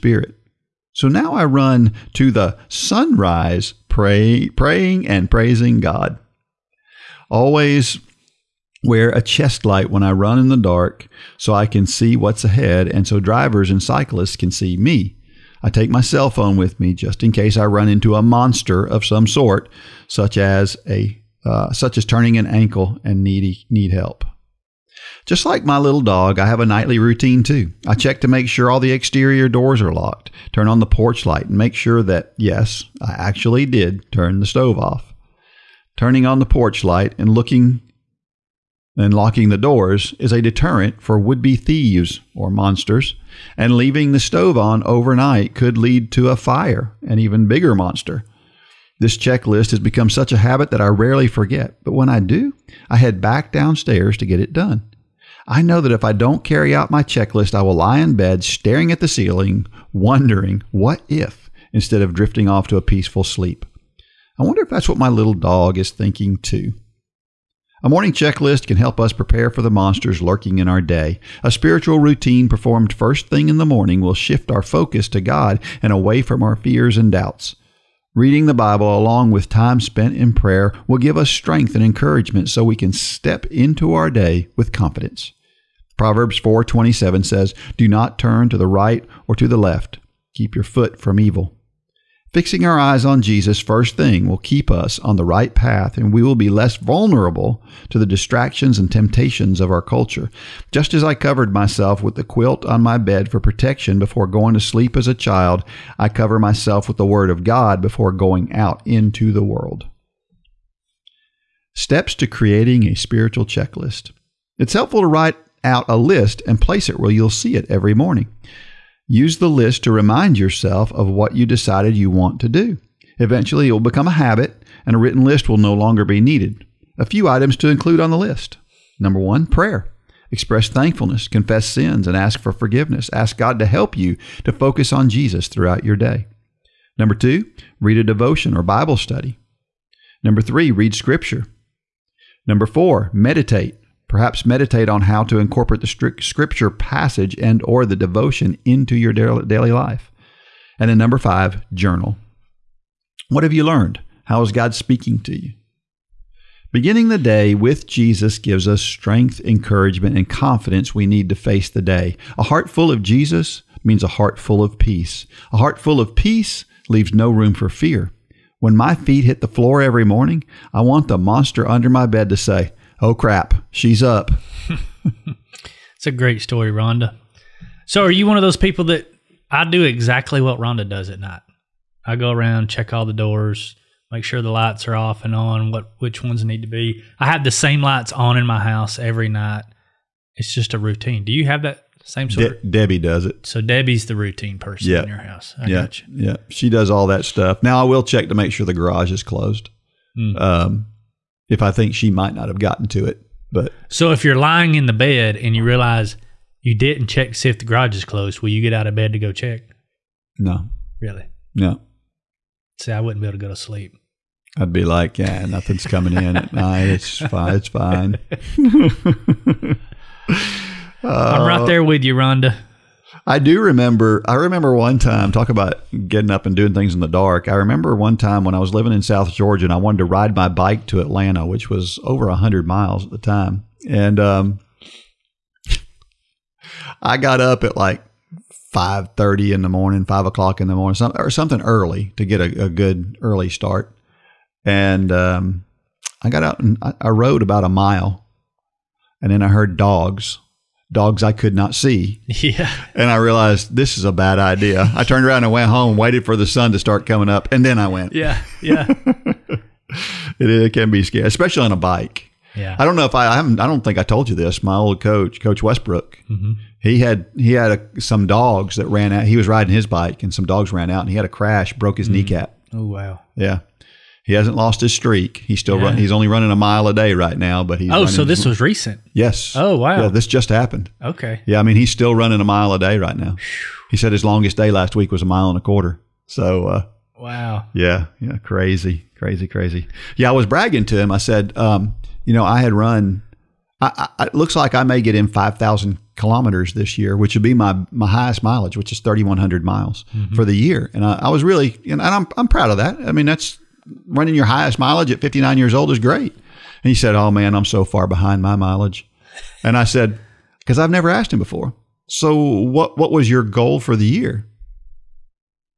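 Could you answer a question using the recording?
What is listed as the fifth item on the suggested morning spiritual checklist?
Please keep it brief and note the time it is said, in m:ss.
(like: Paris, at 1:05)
journal, at 2:31.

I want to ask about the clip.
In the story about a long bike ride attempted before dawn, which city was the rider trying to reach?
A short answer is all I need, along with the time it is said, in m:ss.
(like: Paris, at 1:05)
Atlanta, at 3:51.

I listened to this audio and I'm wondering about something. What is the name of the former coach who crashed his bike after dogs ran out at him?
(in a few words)
Coach Westbrook.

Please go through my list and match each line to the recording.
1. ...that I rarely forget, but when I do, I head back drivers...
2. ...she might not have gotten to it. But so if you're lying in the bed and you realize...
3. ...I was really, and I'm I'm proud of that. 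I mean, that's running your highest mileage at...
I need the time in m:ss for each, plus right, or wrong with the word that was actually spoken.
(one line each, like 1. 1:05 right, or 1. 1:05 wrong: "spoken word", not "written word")
1. 0:50 wrong: "downstairs", not "drivers"
2. 3:21 right
3. 5:01 right.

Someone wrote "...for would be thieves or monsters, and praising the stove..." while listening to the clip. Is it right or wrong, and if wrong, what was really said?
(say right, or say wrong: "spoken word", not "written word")
wrong: "leaving", not "praising".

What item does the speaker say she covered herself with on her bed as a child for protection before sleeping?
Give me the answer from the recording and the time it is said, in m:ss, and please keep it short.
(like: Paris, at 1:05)
the quilt, at 1:42.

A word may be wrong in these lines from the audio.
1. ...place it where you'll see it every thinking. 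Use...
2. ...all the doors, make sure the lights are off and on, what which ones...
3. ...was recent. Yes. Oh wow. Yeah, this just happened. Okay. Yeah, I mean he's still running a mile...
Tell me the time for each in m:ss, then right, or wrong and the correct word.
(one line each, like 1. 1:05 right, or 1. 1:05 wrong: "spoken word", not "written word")
1. 1:56 wrong: "morning", not "thinking"
2. 3:02 right
3. 4:38 right.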